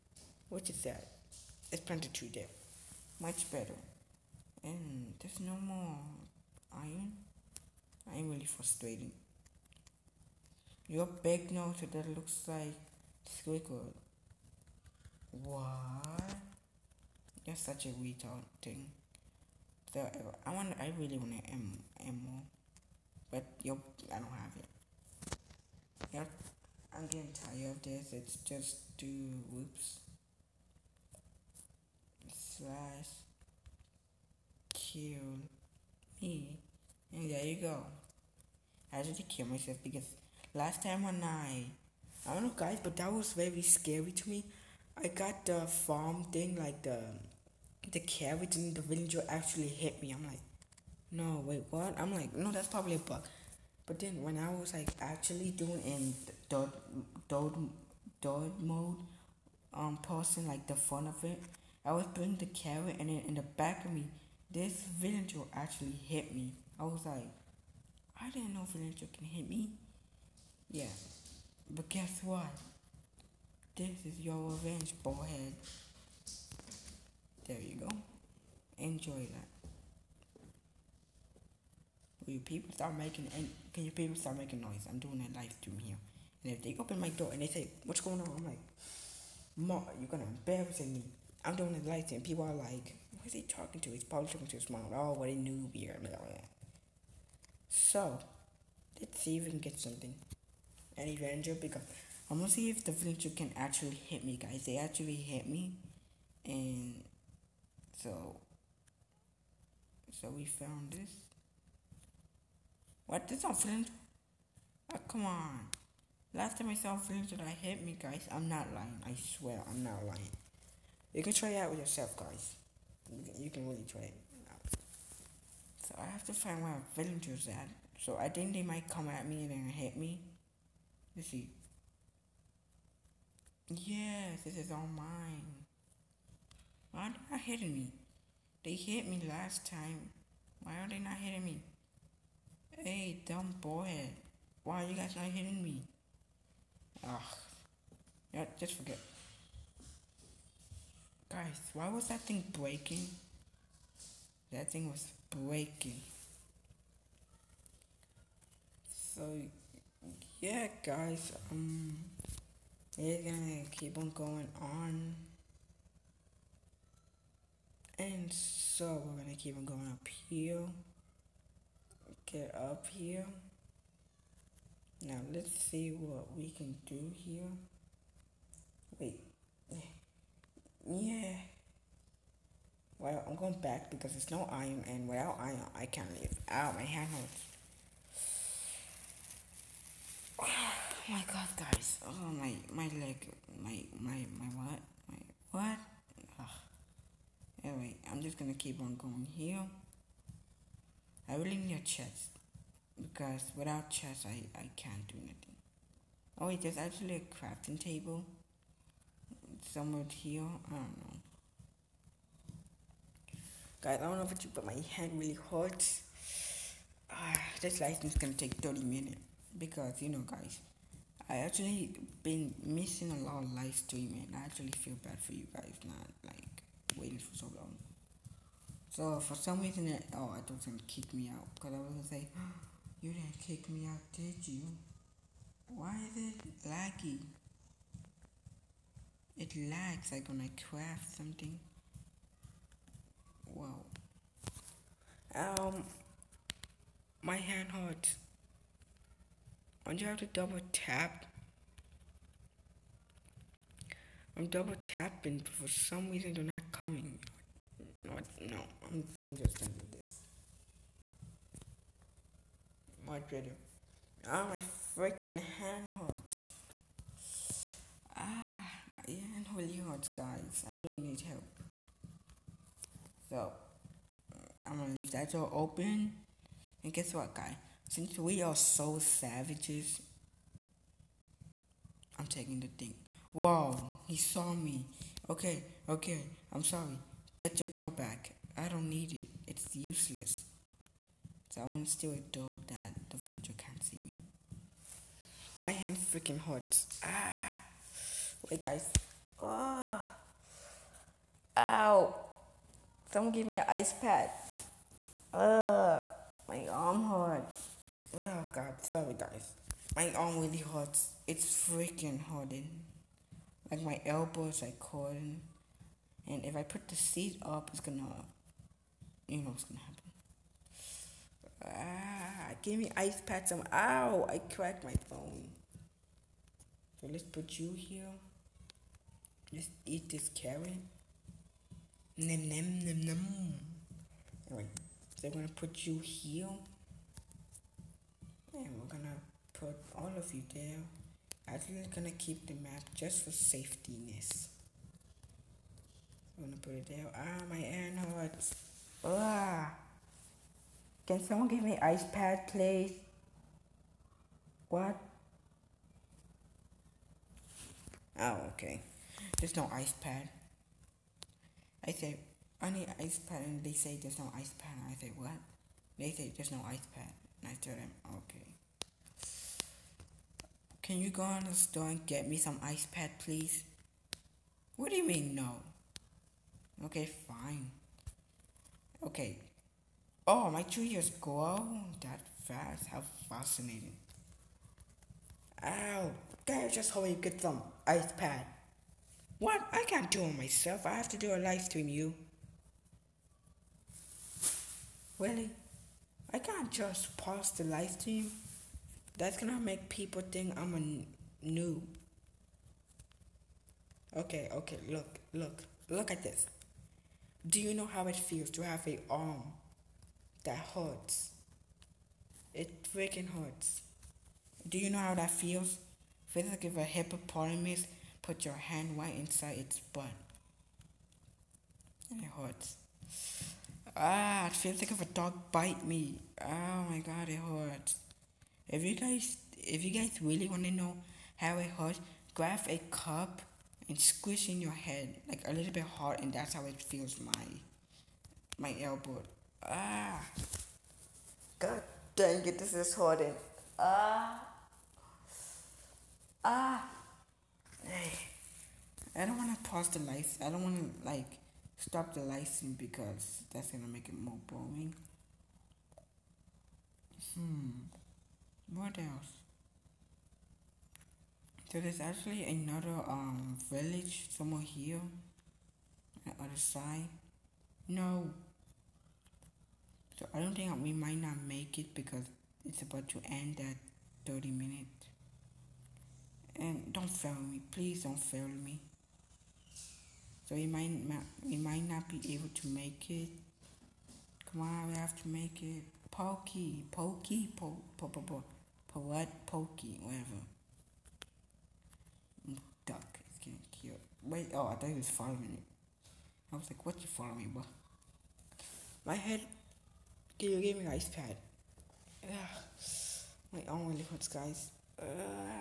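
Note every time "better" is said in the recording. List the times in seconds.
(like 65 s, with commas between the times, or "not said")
3 s, 263 s.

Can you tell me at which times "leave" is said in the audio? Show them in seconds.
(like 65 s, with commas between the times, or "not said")
186 s, 274 s.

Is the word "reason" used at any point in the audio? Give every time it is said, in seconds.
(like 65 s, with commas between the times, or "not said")
229 s, 256 s.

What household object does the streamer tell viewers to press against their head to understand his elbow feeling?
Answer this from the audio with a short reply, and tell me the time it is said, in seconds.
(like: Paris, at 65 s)
cup, at 432 s.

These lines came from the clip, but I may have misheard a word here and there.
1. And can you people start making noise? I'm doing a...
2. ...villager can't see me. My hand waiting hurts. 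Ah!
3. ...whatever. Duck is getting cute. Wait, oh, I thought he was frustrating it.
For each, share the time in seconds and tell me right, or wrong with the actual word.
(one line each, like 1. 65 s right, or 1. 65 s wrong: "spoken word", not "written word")
1. 83 s right
2. 293 s wrong: "freaking", not "waiting"
3. 490 s wrong: "following", not "frustrating".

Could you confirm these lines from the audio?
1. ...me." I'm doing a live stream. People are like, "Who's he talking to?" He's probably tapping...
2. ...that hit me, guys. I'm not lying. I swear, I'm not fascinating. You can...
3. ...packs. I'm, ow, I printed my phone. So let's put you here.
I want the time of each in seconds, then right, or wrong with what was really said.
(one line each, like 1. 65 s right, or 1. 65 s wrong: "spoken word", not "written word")
1. 90 s wrong: "talking", not "tapping"
2. 117 s wrong: "lying", not "fascinating"
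3. 323 s wrong: "cracked", not "printed".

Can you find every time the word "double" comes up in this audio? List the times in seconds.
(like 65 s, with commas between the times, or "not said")
250 s, 254 s.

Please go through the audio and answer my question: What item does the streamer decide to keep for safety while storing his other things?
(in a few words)
map.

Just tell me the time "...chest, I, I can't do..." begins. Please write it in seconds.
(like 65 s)
203 s.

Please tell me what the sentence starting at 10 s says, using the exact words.
Your are back now, so that looks like Squidward.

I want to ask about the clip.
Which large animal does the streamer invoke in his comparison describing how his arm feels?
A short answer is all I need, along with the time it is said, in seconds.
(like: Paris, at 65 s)
hippopotamus, at 416 s.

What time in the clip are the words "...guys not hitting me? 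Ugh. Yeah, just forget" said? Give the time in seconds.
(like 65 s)
144 s.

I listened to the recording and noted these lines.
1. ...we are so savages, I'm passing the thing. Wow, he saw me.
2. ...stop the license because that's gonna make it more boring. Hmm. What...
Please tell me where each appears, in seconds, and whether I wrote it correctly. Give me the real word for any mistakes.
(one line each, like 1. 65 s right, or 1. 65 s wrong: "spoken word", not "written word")
1. 278 s wrong: "taking", not "passing"
2. 451 s right.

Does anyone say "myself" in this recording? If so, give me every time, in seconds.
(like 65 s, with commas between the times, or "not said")
39 s, 390 s.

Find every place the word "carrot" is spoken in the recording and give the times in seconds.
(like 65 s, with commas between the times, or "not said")
47 s, 62 s, 330 s.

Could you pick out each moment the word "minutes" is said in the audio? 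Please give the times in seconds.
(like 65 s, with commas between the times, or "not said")
218 s, 474 s.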